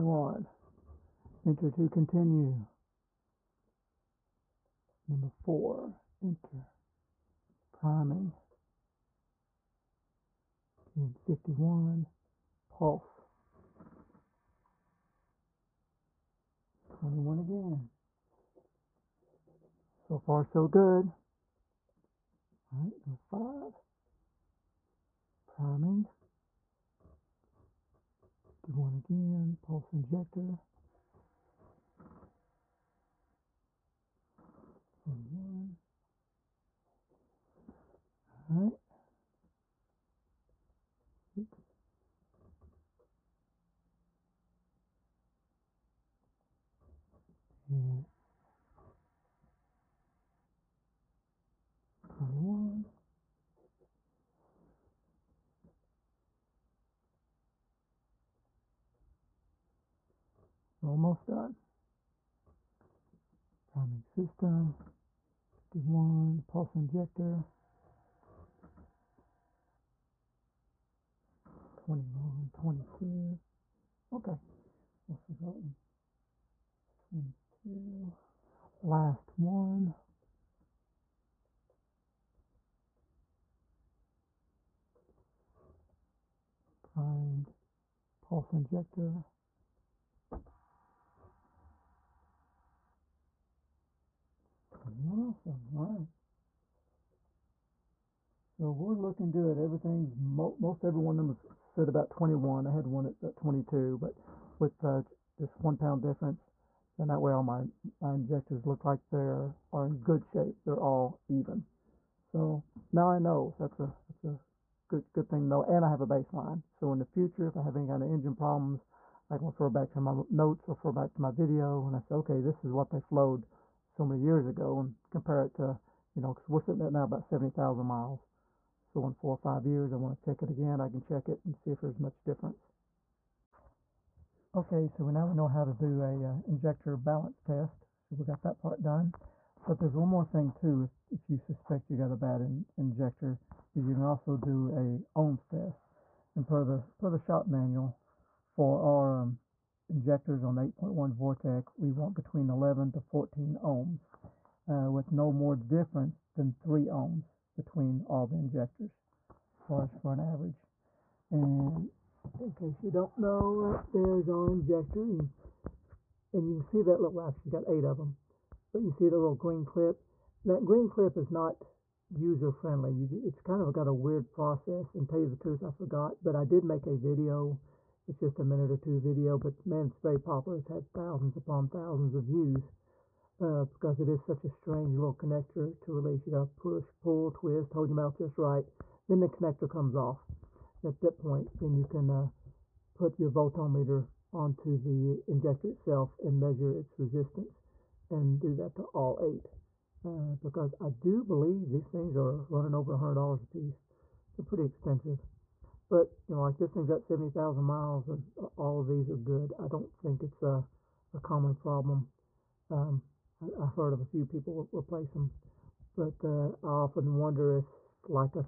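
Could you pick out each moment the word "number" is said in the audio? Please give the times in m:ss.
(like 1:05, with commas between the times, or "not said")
0:05, 0:23.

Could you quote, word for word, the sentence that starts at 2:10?
I can check it and see if there's much difference.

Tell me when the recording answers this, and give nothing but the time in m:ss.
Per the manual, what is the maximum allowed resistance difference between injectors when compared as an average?
2:36.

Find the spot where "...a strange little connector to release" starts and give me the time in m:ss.
3:04.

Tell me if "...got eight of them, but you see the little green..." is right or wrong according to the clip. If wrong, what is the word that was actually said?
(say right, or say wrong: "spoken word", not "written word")
right.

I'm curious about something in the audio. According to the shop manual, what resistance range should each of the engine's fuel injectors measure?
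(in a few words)
11 to 14 ohms.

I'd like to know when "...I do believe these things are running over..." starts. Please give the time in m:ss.
3:20.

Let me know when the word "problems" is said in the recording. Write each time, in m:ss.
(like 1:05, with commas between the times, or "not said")
1:58, 3:31.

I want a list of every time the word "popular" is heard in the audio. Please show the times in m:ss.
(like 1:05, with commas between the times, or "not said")
3:00.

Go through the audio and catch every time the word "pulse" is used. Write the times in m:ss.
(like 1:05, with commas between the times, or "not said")
0:12, 0:29, 1:06, 1:28.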